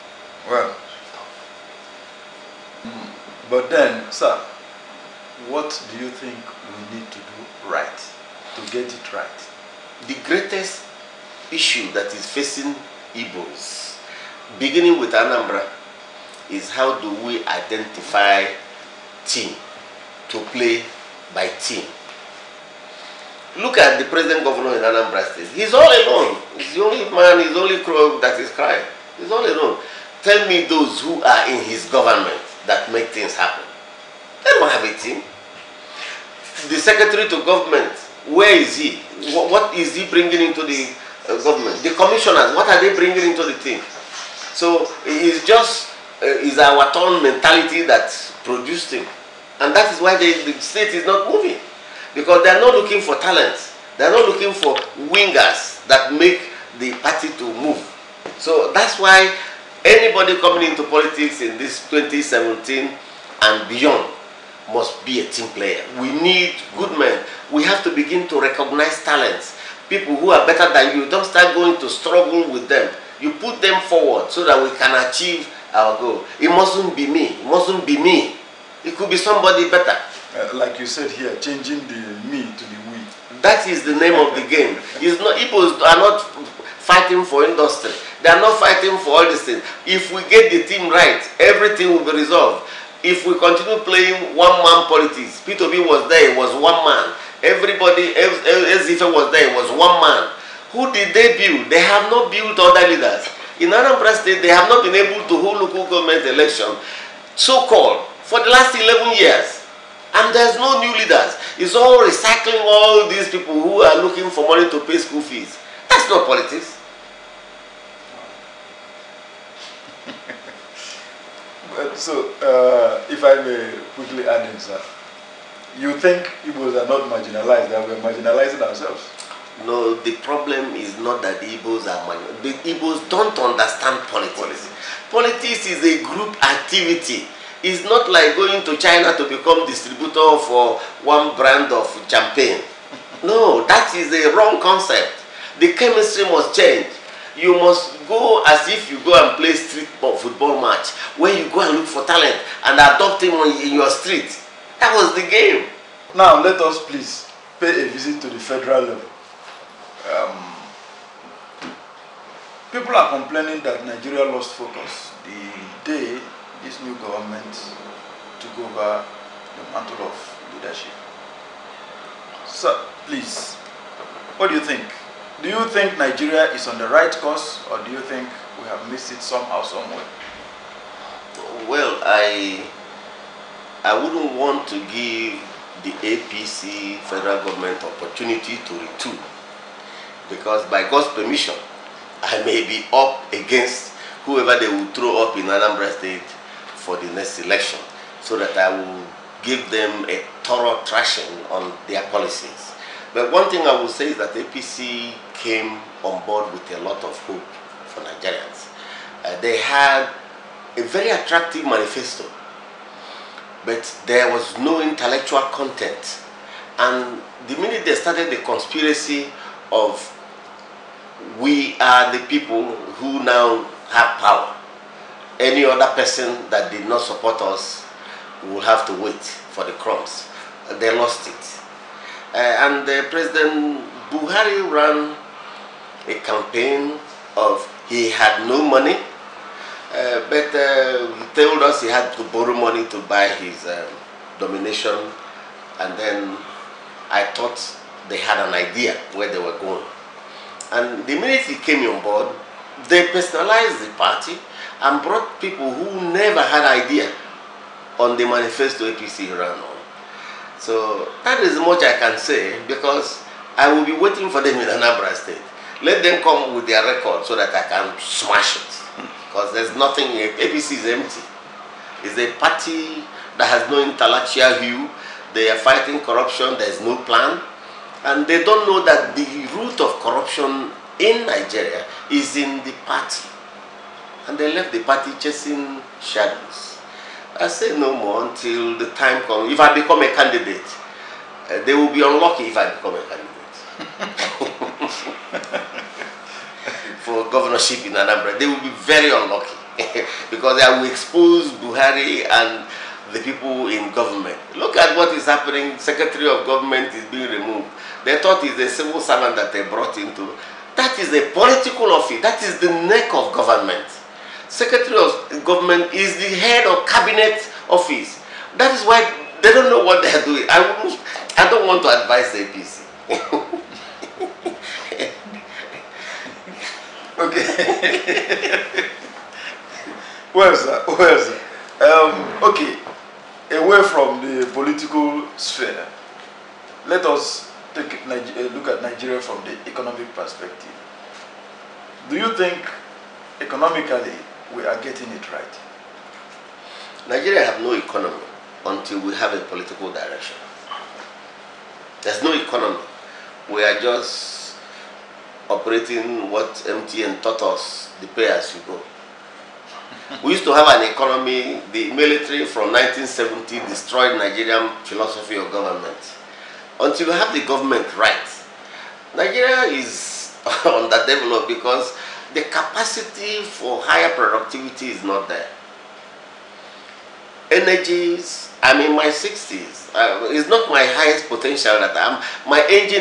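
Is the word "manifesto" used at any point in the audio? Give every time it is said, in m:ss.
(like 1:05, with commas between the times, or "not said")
3:31, 4:18.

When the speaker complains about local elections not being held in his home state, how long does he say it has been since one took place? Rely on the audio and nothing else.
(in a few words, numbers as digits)
11 years.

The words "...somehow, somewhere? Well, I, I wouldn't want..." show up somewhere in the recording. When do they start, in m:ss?
2:59.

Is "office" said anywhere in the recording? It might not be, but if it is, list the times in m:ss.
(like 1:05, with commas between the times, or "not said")
5:11, 5:17.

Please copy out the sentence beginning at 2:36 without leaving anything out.
Now let us please pay a visit to the federal level.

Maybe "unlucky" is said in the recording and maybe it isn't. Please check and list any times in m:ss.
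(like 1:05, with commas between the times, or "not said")
4:52, 4:59.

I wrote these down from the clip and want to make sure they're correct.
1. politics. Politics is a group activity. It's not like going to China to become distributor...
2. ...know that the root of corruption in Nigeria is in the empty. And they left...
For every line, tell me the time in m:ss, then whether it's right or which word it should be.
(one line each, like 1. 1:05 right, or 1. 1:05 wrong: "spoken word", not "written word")
1. 2:14 right
2. 4:38 wrong: "party", not "empty".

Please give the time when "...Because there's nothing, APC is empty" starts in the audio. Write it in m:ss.
4:29.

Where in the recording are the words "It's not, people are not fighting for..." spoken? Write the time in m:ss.
1:24.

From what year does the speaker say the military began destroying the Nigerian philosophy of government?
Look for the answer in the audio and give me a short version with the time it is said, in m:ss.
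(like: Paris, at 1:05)
1970, at 6:02.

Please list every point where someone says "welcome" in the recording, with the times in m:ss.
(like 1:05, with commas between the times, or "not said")
not said.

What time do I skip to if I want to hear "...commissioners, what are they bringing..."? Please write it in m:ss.
0:41.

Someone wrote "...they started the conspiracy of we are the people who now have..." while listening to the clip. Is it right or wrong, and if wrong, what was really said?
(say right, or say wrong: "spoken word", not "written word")
right.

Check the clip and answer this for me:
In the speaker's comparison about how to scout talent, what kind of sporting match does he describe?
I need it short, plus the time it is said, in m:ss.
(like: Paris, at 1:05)
Street football match, at 2:29.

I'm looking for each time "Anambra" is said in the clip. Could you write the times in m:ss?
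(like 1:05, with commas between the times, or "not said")
0:15, 0:24, 1:43, 3:15, 4:24, 4:57.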